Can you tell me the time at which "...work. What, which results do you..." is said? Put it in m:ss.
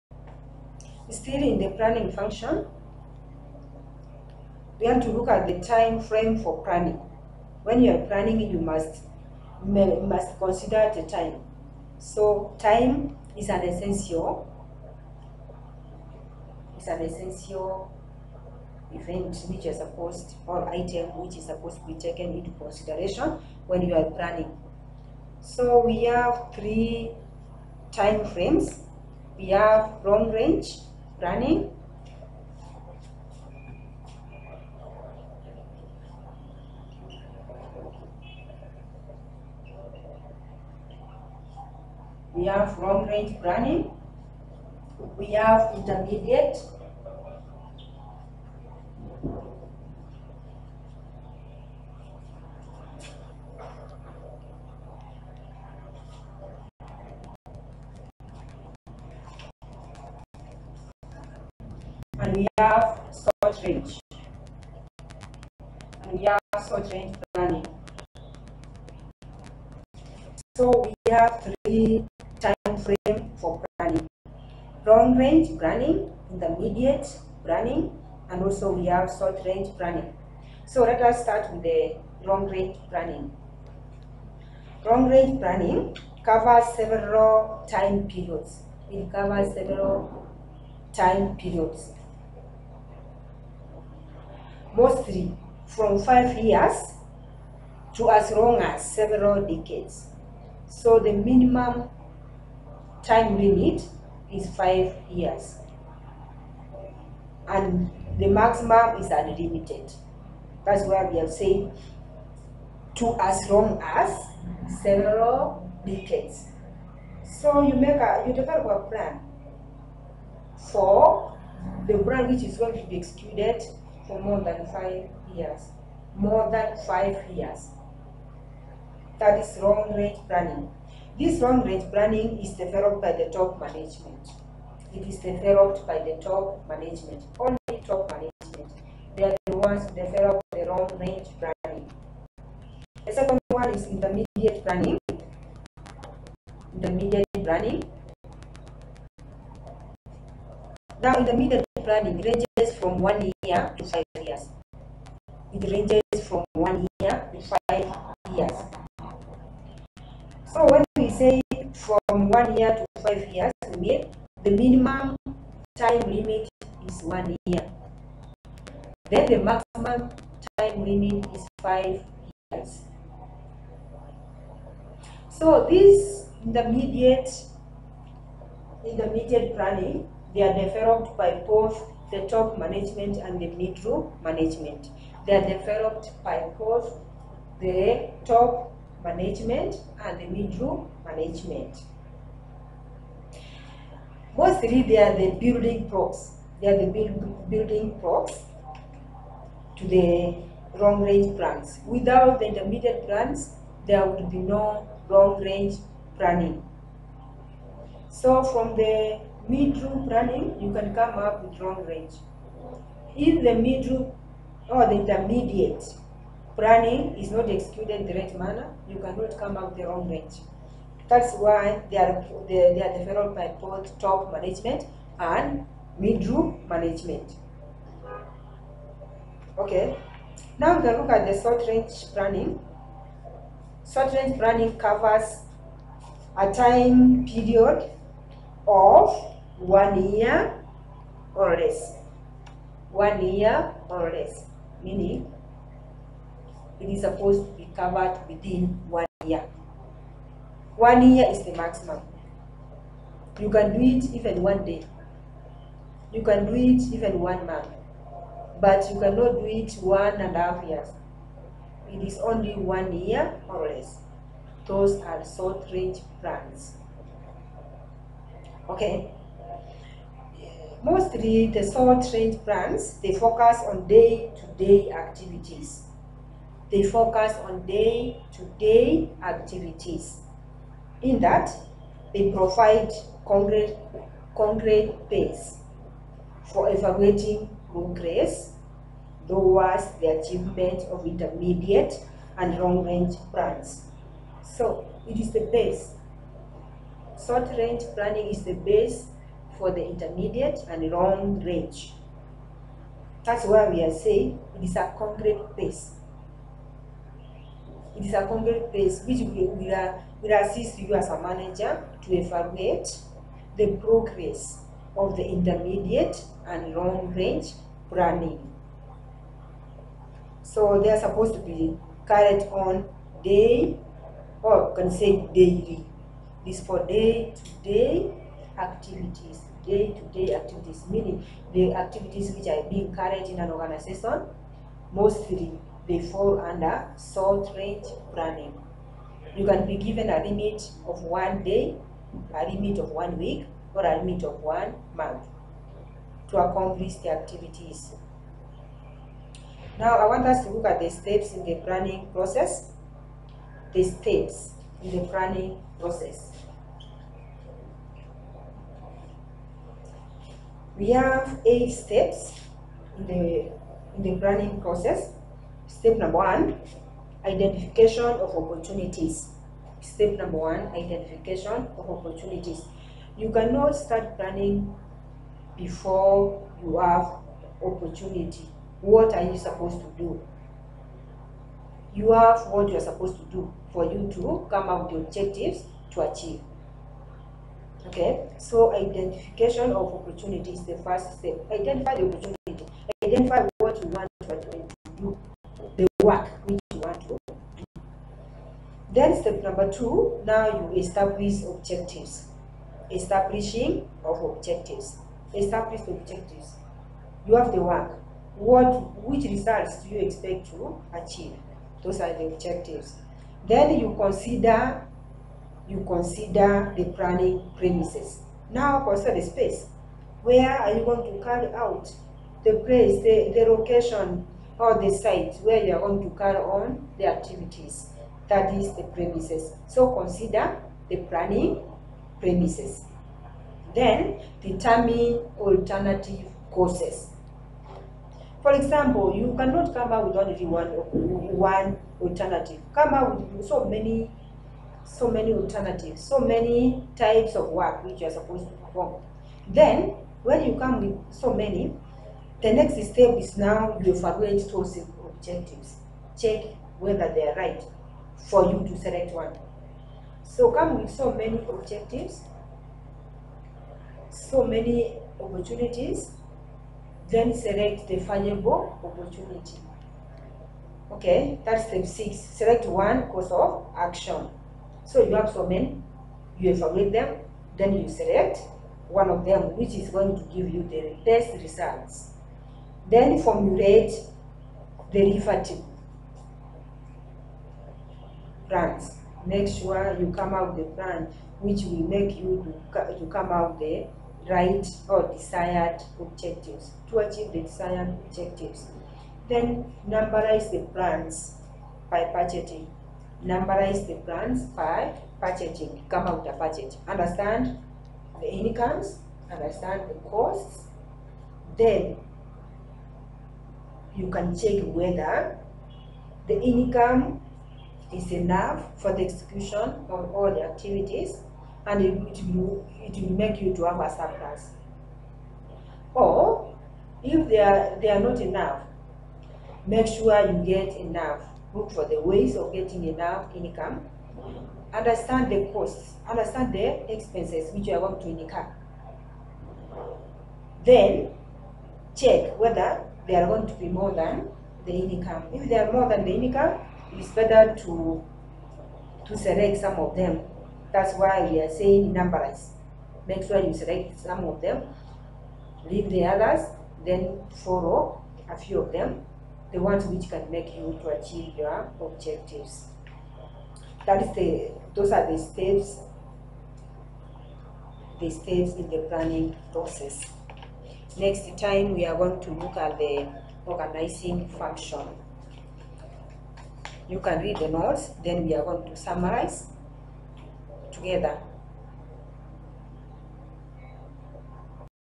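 6:47.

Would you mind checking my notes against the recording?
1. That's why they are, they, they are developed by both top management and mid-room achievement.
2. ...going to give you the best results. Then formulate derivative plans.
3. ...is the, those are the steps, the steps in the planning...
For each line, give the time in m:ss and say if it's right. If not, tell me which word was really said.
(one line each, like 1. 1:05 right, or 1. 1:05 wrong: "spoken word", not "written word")
1. 3:41 wrong: "management", not "achievement"
2. 7:59 right
3. 9:24 right.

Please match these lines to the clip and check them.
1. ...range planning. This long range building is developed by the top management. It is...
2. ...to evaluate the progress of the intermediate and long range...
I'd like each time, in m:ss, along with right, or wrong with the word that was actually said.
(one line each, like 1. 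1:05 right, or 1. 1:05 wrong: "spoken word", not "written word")
1. 2:09 wrong: "planning", not "building"
2. 5:12 right.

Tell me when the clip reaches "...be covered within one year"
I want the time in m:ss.
4:07.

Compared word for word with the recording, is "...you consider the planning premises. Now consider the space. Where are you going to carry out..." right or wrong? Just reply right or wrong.
right.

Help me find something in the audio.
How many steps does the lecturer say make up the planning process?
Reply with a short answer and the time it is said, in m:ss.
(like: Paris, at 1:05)
8, at 6:01.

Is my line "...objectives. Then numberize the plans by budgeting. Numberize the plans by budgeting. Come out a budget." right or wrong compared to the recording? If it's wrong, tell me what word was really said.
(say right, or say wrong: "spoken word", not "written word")
right.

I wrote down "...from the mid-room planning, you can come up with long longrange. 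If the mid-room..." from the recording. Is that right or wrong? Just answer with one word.
wrong.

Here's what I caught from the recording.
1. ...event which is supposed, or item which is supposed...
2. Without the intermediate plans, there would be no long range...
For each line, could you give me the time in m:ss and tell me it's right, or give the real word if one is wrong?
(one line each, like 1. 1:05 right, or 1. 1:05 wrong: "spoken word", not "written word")
1. 0:18 right
2. 3:21 right.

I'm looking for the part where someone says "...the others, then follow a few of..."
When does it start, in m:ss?
9:15.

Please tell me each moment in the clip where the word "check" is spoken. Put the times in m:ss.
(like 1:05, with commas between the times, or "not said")
7:36, 8:34, 9:01.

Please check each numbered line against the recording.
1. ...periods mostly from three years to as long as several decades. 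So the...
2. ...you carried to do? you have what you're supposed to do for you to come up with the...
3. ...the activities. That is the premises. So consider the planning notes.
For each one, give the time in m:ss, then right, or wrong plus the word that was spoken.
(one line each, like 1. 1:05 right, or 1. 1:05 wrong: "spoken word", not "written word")
1. 1:31 wrong: "five", not "three"
2. 6:19 wrong: "supposed", not "carried"
3. 7:06 wrong: "premises", not "notes".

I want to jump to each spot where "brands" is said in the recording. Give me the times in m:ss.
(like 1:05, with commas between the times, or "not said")
2:01, 4:32, 4:53.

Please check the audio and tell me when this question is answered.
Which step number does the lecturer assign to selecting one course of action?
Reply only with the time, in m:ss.
7:51.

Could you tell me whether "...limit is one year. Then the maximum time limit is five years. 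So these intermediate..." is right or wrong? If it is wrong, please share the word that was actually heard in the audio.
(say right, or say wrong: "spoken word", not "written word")
right.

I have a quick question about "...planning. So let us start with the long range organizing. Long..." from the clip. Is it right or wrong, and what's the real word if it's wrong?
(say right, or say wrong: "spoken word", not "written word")
wrong: "planning", not "organizing".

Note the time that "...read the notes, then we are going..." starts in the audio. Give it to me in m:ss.
9:37.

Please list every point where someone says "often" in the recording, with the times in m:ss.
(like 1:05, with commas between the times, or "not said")
not said.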